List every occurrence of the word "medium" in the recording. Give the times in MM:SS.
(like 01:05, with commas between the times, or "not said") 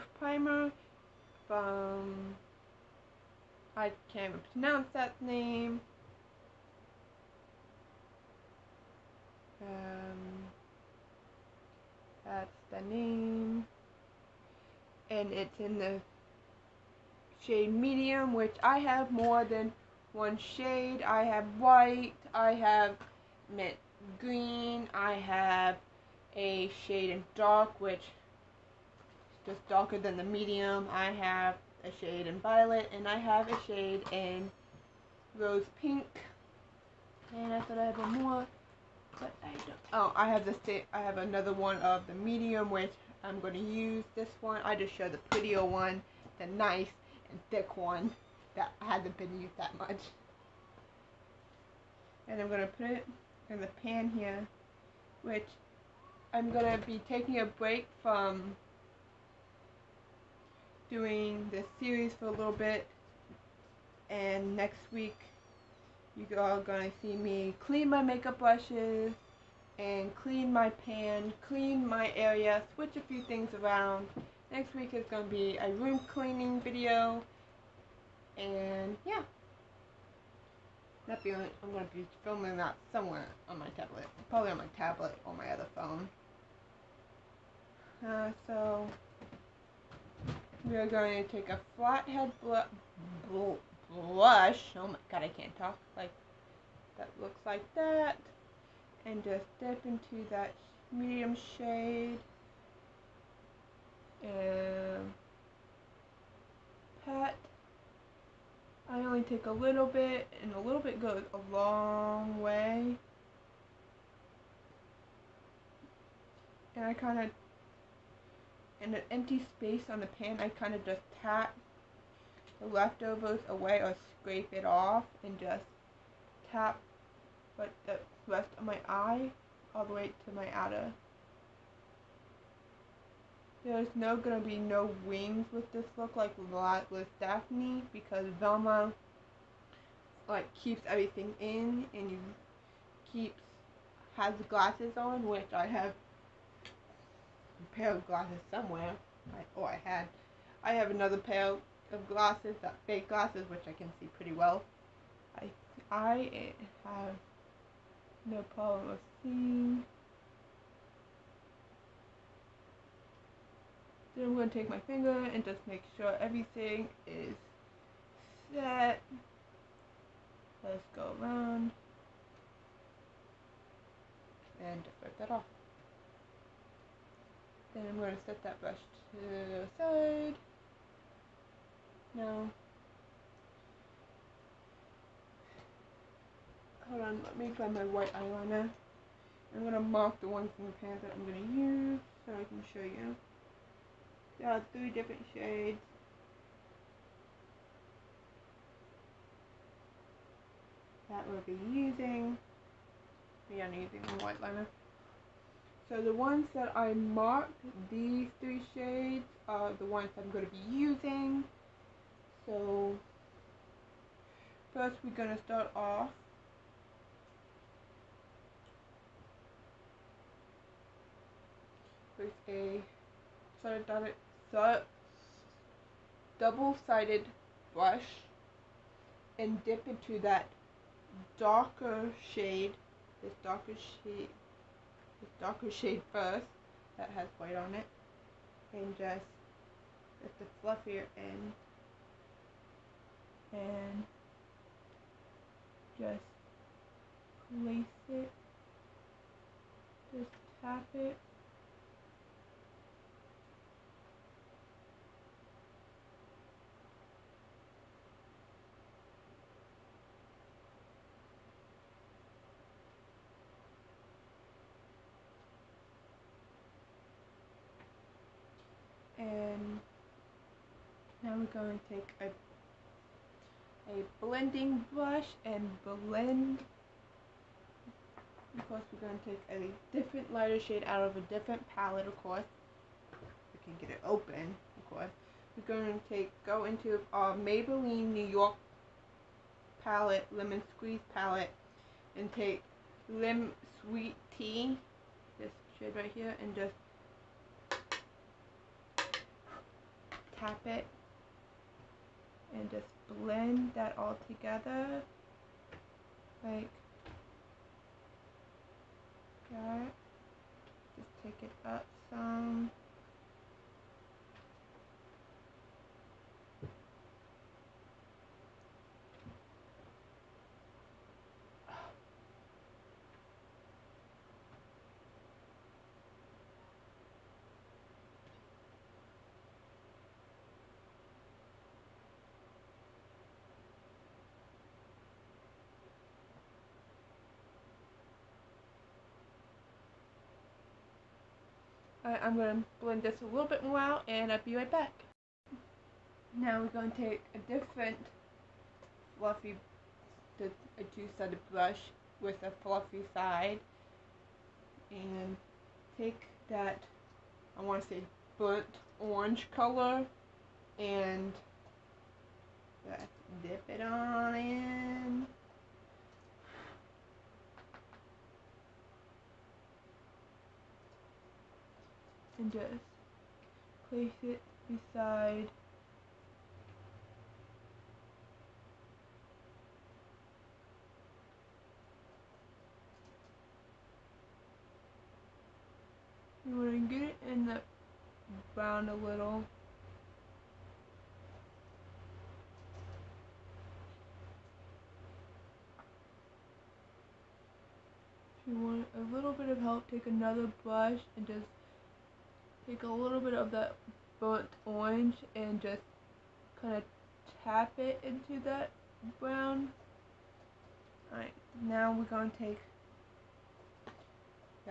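00:17, 00:30, 00:42, 01:40.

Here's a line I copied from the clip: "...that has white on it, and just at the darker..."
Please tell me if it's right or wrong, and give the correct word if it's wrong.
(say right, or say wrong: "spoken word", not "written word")
wrong: "fluffier", not "darker".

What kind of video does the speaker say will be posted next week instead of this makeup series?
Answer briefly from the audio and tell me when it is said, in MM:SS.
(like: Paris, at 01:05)
room cleaning video, at 01:15.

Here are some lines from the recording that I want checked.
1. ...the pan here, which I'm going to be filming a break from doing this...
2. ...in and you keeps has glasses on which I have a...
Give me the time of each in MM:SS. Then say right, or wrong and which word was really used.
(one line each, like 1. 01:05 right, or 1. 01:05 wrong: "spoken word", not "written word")
1. 00:53 wrong: "taking", not "filming"
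2. 02:21 right.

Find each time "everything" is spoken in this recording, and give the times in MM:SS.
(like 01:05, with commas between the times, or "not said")
02:20, 02:46.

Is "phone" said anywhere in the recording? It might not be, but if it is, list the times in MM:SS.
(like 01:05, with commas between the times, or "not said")
01:25.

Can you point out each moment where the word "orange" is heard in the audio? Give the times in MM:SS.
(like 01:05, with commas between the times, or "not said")
05:58, 06:44.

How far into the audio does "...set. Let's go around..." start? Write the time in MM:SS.
02:48.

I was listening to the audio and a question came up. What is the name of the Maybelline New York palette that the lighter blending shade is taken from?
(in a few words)
lemon squeeze.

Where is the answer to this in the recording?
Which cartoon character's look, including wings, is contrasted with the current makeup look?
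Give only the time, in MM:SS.
02:17.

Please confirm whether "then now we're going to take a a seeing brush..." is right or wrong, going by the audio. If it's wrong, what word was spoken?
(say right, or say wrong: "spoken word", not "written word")
wrong: "blending", not "seeing".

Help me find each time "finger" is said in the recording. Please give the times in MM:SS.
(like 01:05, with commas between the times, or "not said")
02:44.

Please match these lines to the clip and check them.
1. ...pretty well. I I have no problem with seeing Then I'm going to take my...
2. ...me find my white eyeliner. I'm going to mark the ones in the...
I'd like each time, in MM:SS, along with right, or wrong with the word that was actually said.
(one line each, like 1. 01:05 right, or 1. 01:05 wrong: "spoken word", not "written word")
1. 02:34 right
2. 03:07 right.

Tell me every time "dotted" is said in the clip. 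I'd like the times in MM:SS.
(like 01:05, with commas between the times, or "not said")
03:44.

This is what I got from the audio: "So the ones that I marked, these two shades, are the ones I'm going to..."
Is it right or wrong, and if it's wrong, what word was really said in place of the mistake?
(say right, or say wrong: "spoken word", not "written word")
wrong: "three", not "two".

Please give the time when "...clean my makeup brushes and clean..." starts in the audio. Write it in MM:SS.
01:07.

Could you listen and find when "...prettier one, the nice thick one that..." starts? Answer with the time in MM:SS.
00:45.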